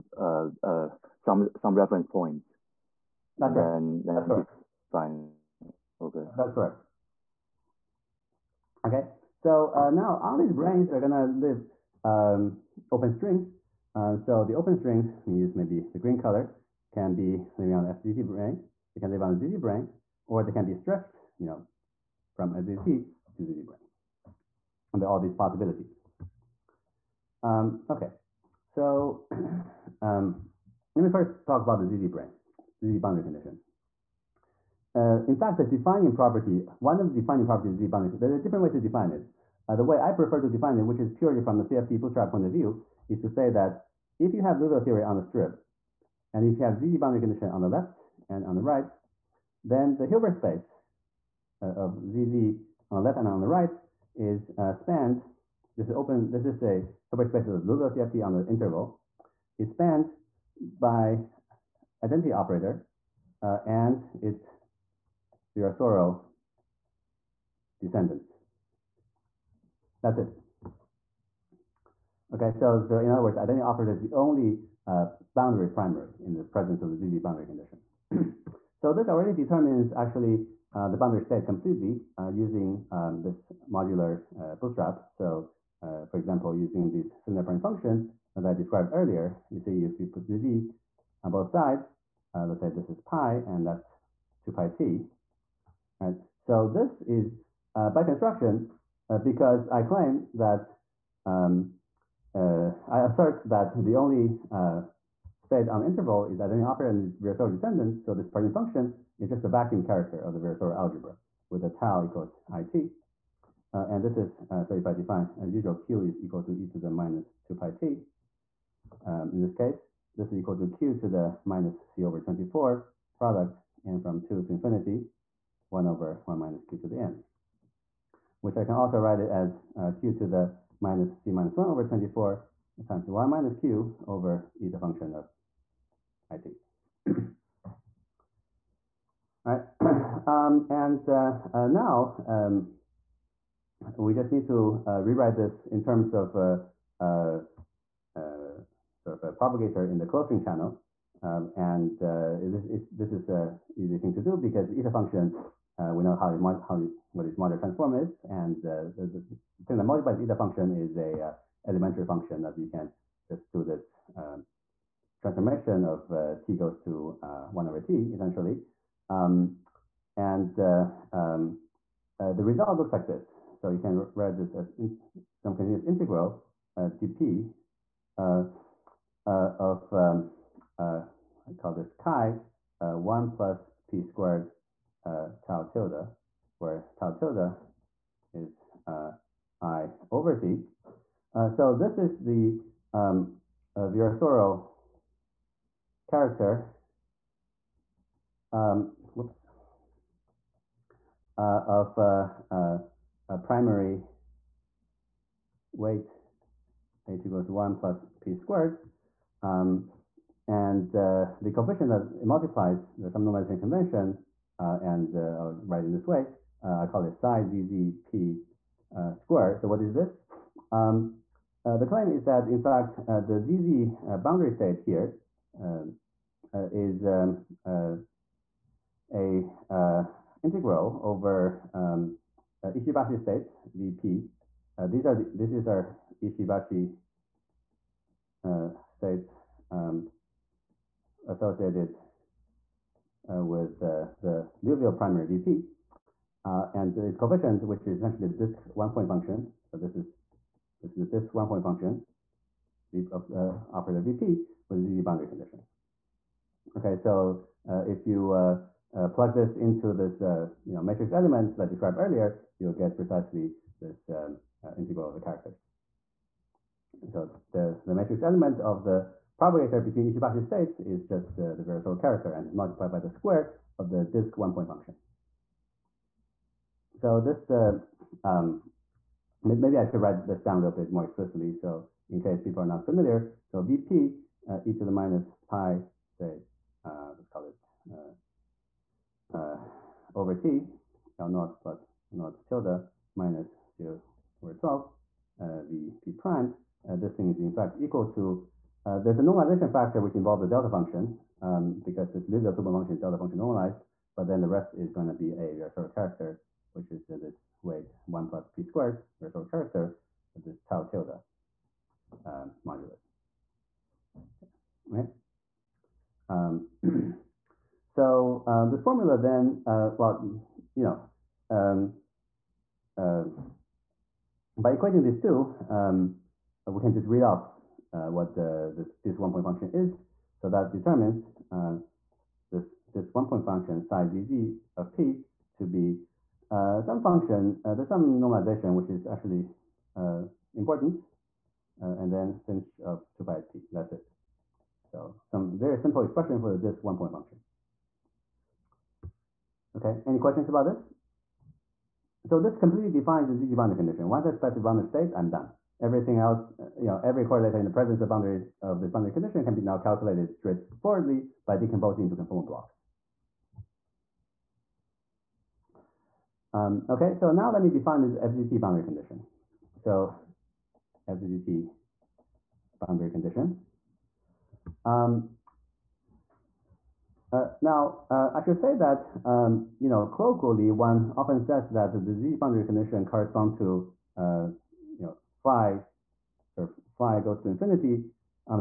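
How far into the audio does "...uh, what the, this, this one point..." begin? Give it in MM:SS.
05:27.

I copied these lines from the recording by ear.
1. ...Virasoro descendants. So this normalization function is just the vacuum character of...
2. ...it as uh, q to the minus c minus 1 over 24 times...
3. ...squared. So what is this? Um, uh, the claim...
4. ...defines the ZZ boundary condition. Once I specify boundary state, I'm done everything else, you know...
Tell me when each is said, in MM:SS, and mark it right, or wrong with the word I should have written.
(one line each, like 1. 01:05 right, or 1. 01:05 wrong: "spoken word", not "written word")
1. 01:47 wrong: "partition", not "normalization"
2. 02:09 right
3. 03:39 right
4. 05:52 right.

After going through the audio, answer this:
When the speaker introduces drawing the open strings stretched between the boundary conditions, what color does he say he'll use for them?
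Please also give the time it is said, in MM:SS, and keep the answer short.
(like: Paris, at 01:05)
green, at 00:15.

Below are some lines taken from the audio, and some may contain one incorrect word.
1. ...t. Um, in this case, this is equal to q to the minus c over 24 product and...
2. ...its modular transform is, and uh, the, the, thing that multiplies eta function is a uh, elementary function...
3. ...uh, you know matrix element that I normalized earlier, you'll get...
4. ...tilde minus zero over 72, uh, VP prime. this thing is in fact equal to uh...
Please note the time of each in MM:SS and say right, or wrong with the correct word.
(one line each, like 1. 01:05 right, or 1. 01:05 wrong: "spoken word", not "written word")
1. 01:57 right
2. 02:37 right
3. 04:20 wrong: "described", not "normalized"
4. 04:52 wrong: "12", not "72".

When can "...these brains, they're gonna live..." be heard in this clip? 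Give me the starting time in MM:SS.
00:10.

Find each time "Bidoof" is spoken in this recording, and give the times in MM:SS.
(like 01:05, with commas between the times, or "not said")
not said.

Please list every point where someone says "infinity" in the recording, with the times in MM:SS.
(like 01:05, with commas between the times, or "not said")
02:04, 06:27.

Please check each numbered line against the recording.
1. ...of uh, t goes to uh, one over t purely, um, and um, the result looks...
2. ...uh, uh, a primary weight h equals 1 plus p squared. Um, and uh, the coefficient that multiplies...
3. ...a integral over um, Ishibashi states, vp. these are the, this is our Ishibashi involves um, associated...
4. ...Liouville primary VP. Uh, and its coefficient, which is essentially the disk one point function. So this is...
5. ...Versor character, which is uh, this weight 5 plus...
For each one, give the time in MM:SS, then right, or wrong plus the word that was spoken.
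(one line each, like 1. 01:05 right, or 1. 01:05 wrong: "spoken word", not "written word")
1. 02:45 wrong: "essentially", not "purely"
2. 03:21 right
3. 03:49 wrong: "states", not "involves"
4. 04:04 right
5. 05:05 wrong: "1", not "5".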